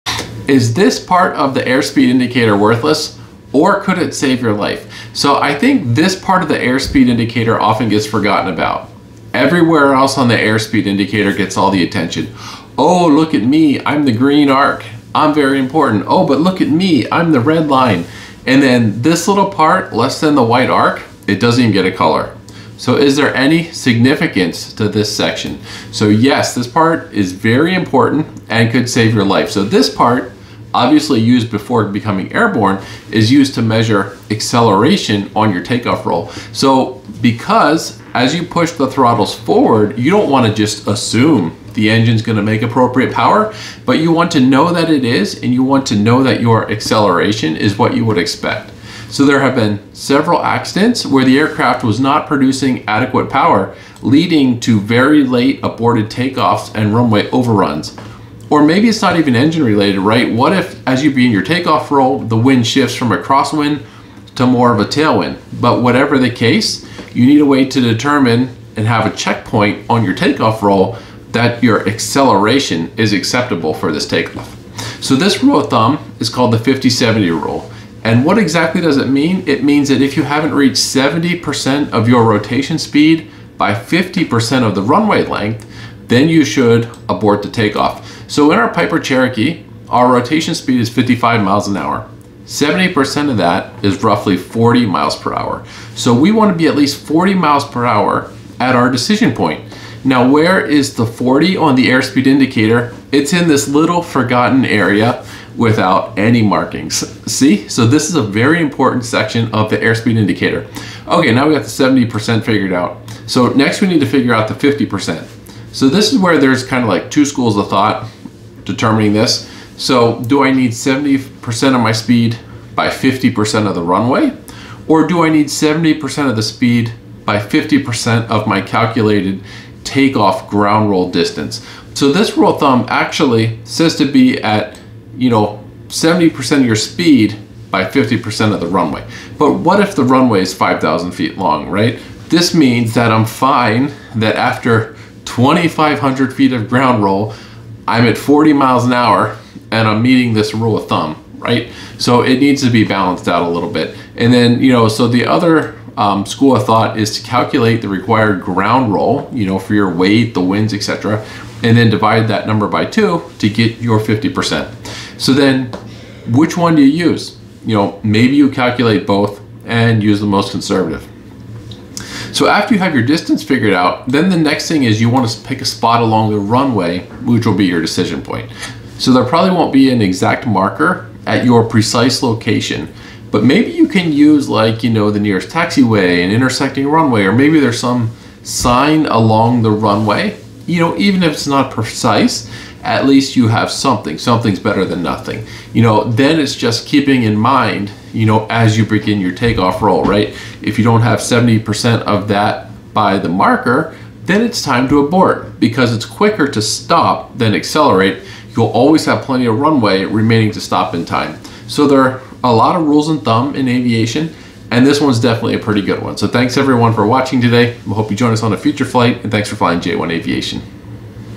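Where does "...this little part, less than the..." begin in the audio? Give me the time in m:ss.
0:19.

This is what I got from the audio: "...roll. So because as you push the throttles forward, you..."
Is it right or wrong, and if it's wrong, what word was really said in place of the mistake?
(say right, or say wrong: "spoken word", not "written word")
right.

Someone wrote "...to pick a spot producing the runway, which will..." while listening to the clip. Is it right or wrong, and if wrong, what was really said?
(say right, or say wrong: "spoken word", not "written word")
wrong: "along", not "producing".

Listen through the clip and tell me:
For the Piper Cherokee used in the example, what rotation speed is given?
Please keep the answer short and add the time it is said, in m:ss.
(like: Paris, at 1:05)
55 miles an hour, at 1:30.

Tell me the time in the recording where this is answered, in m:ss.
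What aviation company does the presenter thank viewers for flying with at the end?
3:39.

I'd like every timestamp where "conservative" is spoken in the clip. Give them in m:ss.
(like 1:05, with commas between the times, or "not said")
2:50.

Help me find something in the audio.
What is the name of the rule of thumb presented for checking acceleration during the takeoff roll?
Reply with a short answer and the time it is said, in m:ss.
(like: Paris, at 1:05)
50-70 rule, at 1:16.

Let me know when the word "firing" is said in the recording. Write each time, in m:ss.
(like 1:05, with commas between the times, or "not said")
not said.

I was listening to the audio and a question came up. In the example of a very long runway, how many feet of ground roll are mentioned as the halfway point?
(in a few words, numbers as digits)
2,500 feet.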